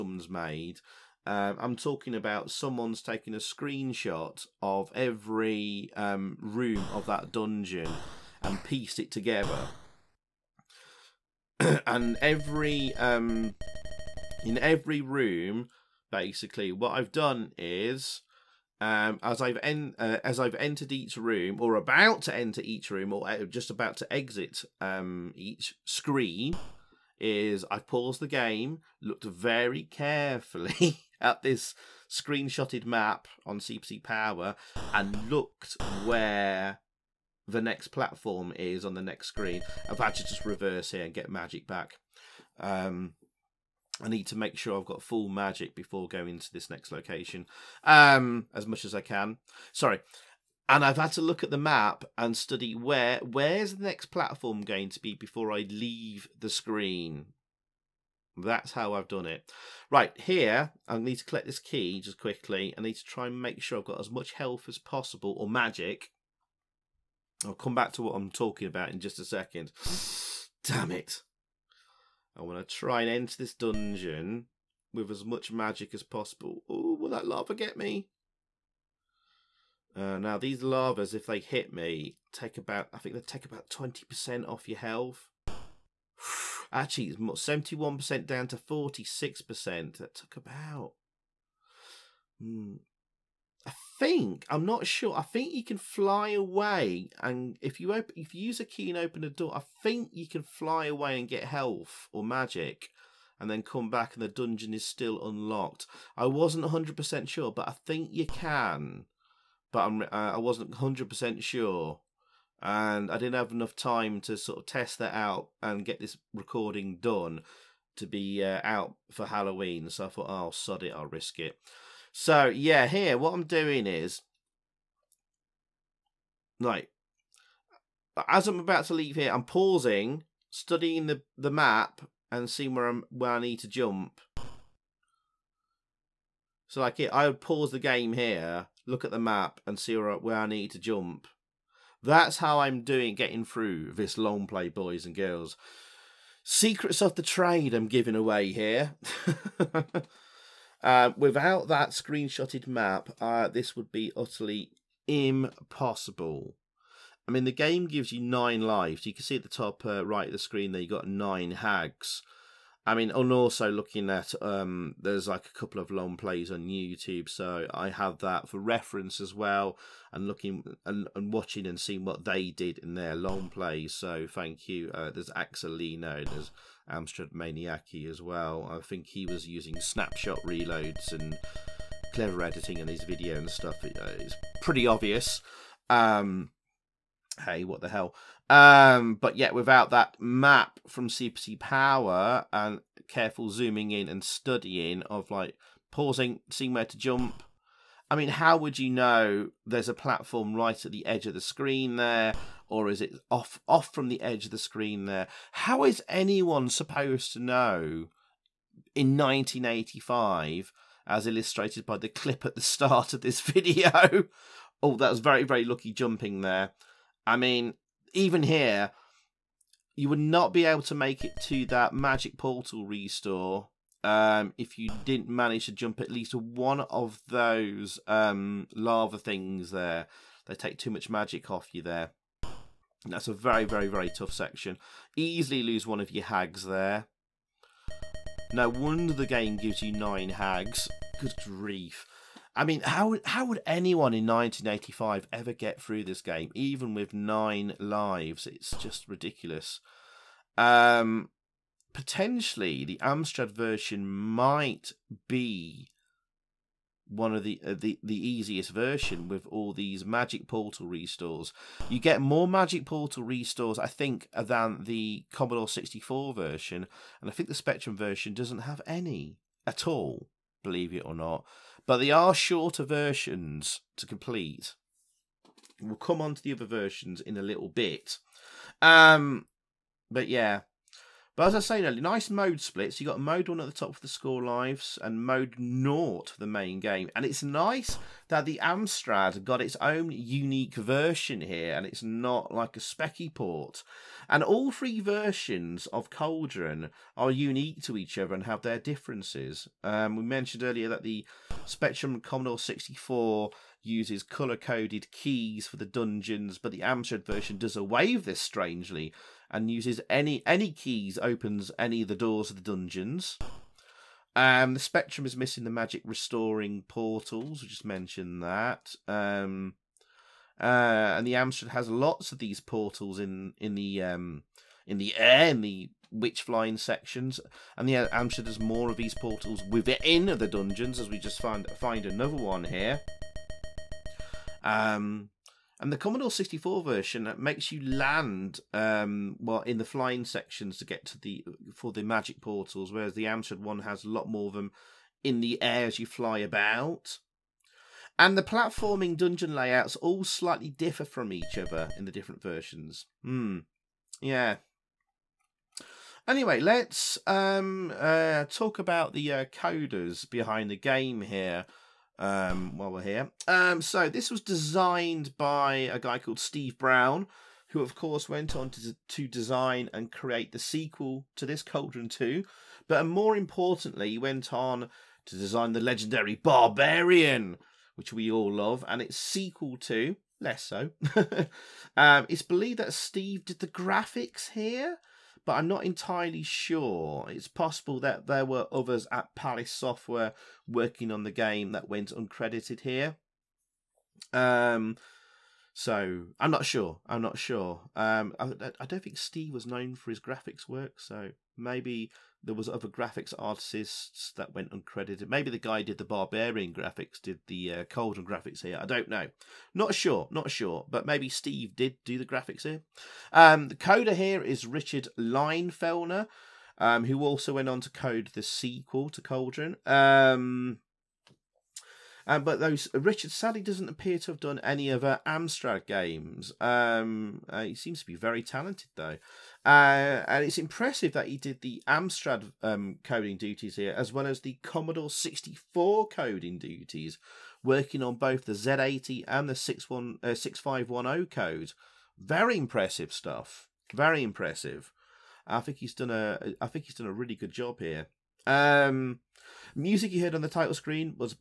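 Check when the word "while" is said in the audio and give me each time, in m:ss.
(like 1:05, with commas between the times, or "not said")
6:02.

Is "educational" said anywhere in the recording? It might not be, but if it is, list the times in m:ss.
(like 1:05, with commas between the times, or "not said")
not said.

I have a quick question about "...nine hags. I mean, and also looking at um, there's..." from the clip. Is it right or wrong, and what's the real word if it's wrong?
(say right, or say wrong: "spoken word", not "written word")
right.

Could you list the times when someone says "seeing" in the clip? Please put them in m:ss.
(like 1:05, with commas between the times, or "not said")
2:12, 2:51, 3:16.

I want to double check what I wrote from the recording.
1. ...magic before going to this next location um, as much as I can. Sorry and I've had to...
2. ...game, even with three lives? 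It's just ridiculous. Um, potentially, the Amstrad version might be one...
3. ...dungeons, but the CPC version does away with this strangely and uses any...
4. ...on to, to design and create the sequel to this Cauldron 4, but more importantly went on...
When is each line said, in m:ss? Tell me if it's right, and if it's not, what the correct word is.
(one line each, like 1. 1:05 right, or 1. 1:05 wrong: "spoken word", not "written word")
1. 0:45 right
2. 4:06 wrong: "nine", not "three"
3. 5:05 wrong: "Amstrad", not "CPC"
4. 6:08 wrong: "2", not "4".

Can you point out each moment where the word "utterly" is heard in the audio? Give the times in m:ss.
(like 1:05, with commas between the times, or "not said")
2:34.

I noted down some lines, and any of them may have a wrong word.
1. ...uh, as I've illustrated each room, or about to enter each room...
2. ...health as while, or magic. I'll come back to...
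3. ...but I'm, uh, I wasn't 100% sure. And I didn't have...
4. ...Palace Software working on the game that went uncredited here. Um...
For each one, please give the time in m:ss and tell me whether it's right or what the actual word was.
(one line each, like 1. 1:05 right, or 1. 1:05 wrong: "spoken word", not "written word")
1. 0:19 wrong: "entered", not "illustrated"
2. 1:04 wrong: "possible", not "while"
3. 1:49 right
4. 6:29 right.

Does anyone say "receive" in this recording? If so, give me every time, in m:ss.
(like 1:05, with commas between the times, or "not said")
not said.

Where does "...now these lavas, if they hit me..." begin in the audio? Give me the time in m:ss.
1:20.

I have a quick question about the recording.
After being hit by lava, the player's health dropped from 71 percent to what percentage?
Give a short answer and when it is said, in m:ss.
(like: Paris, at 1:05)
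46 percent, at 1:28.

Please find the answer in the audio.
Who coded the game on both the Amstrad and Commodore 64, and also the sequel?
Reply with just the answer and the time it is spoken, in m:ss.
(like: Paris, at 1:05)
Richard Leinfellner, at 6:54.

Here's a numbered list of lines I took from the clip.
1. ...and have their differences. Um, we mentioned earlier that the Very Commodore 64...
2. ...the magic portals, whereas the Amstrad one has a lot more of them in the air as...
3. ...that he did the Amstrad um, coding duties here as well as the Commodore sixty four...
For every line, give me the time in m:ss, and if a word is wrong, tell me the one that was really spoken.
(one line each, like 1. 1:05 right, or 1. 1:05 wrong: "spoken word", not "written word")
1. 4:58 wrong: "Spectrum", not "Very"
2. 5:41 right
3. 7:11 right.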